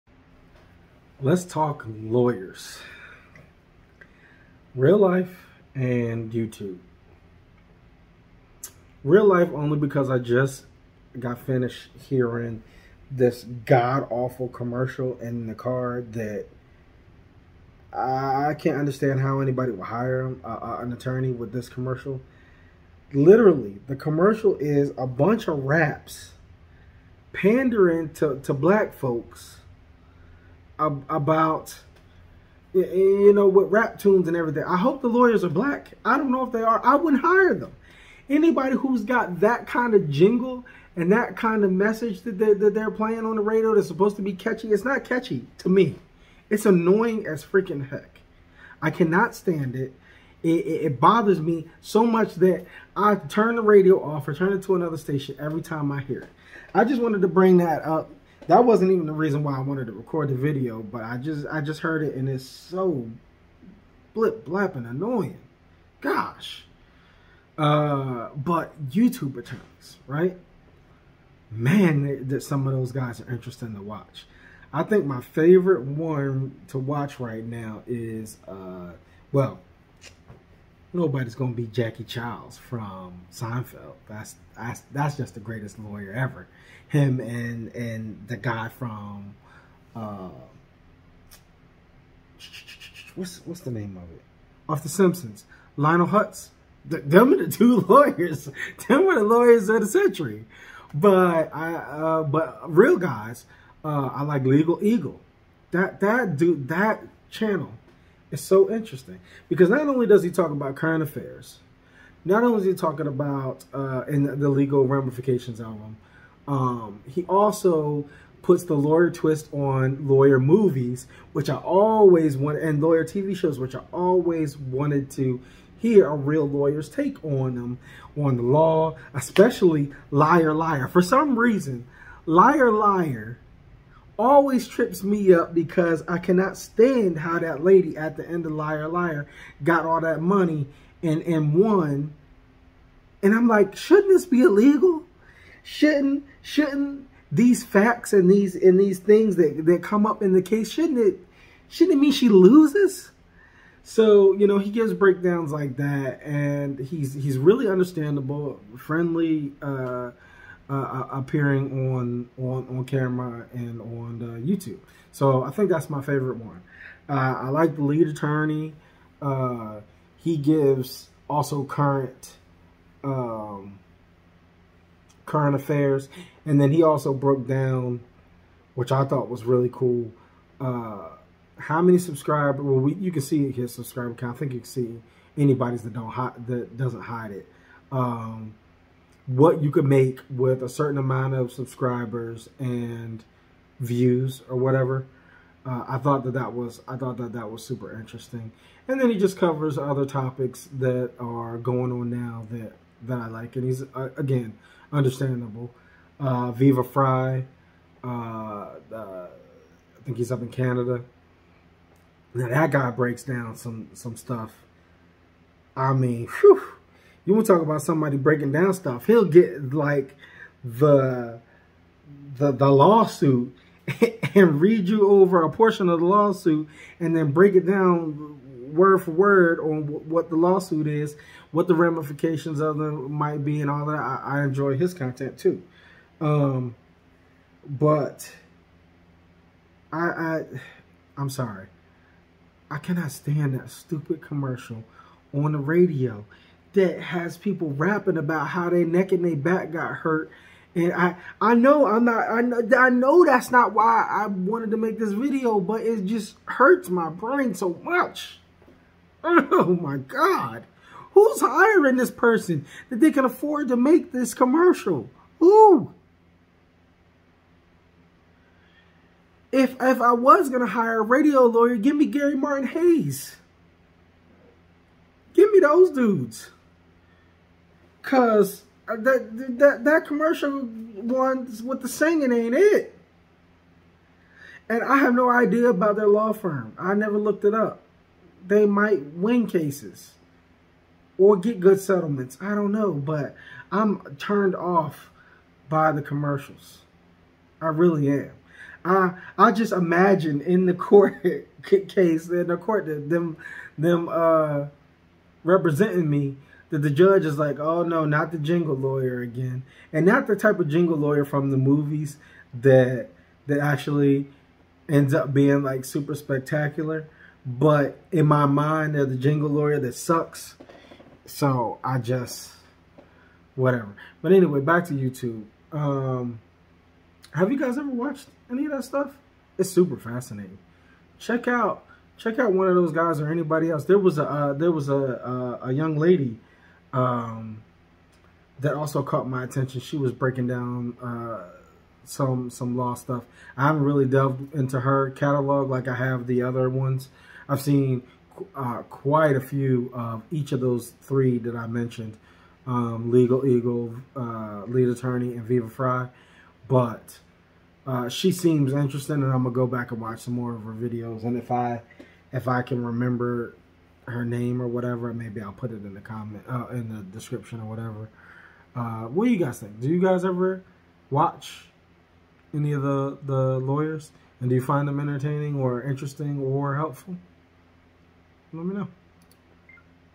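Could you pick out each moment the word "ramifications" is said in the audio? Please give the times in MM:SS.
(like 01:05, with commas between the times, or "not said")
01:54, 03:51.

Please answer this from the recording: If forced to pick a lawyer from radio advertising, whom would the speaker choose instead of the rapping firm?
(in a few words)
Gary Martin Hays.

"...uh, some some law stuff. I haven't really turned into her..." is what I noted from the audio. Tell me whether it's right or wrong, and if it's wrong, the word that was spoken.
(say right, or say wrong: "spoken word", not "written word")
wrong: "delved", not "turned".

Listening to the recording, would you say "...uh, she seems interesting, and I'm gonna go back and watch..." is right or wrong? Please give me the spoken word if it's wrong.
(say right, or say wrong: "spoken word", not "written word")
right.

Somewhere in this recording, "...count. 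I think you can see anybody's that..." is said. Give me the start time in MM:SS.
03:04.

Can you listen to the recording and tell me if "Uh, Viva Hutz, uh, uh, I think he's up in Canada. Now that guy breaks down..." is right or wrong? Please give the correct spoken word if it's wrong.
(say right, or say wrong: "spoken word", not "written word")
wrong: "Frei", not "Hutz".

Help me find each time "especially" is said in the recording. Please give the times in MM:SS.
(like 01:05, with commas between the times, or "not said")
02:09.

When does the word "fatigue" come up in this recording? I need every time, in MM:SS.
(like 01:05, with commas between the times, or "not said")
not said.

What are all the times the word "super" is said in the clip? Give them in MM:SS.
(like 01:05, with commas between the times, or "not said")
03:17, 05:15, 05:29.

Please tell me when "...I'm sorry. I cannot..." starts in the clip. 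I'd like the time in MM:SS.
04:01.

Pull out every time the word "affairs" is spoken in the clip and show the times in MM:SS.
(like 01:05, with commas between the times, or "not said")
01:51, 02:55.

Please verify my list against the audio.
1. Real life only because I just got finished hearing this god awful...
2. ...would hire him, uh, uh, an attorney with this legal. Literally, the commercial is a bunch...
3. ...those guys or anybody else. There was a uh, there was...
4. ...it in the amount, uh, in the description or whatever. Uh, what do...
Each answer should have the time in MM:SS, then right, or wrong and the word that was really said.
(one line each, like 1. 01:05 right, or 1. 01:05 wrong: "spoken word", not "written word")
1. 00:09 right
2. 00:19 wrong: "commercial", not "legal"
3. 05:32 right
4. 06:05 wrong: "comment", not "amount".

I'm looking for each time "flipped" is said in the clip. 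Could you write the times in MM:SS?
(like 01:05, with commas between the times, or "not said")
not said.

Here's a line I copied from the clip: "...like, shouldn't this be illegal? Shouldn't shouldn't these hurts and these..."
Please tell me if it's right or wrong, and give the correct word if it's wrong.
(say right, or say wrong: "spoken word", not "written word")
wrong: "facts", not "hurts".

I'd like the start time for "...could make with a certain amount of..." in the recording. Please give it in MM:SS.
03:09.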